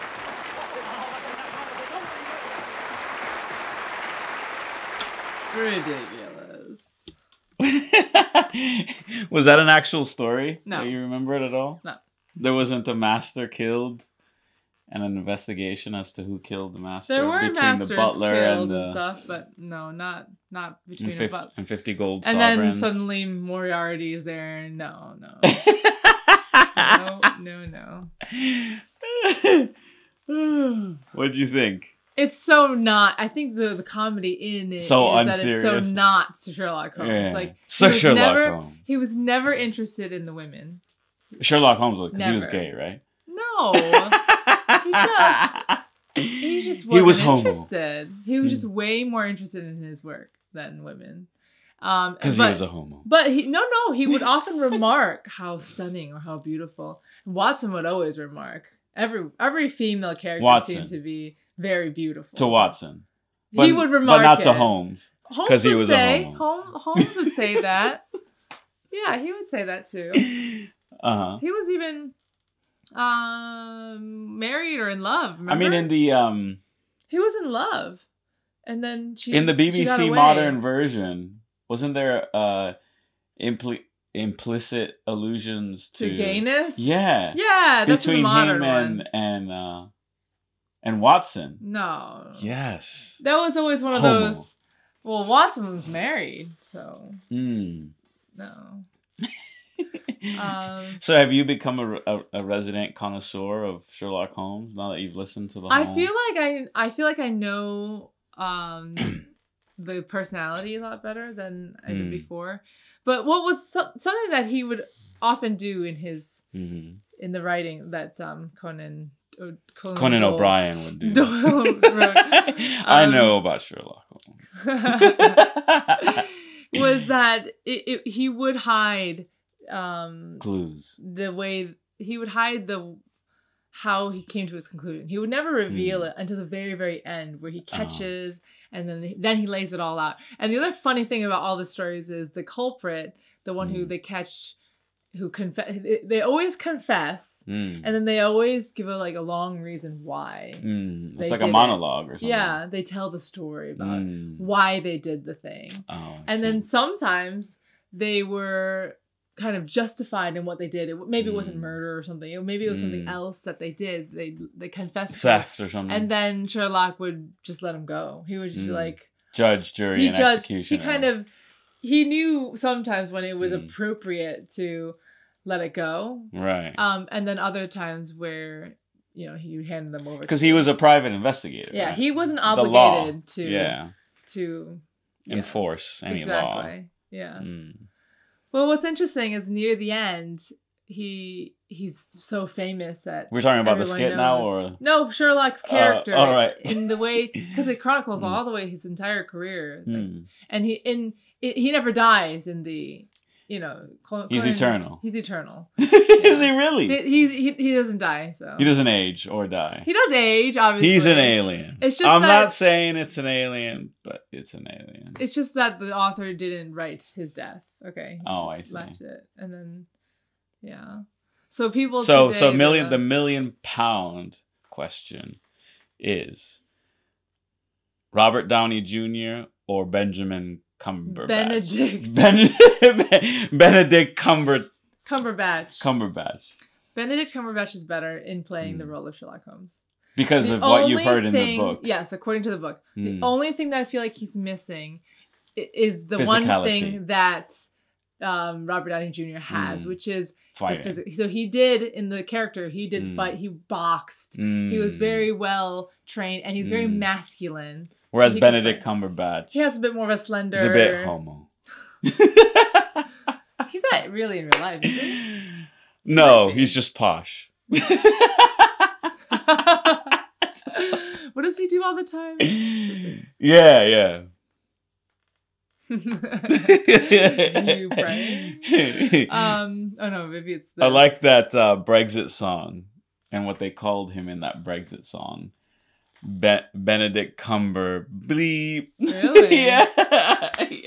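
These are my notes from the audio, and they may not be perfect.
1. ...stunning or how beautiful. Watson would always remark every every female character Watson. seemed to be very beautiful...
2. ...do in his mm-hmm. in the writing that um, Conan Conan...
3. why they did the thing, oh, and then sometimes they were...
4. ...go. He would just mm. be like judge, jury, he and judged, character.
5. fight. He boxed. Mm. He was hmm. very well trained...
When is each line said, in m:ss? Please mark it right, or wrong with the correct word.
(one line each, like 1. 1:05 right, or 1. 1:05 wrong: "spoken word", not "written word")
1. 0:55 right
2. 1:55 right
3. 2:34 right
4. 2:47 wrong: "executioner", not "character"
5. 4:13 right.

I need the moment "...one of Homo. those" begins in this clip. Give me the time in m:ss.
1:33.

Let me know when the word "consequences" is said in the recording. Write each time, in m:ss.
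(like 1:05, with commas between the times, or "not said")
not said.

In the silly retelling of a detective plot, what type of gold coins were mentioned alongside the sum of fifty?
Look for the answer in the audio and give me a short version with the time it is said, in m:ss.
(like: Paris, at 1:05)
sovereigns, at 0:22.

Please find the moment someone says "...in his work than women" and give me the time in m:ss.
0:49.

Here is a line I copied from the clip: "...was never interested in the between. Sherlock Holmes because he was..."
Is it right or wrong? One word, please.
wrong.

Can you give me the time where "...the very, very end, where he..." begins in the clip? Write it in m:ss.
2:16.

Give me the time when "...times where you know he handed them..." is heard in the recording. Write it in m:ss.
2:57.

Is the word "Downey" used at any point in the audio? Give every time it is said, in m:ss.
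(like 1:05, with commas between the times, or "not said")
3:48, 4:08.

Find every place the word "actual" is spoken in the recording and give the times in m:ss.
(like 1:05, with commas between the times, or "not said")
0:09.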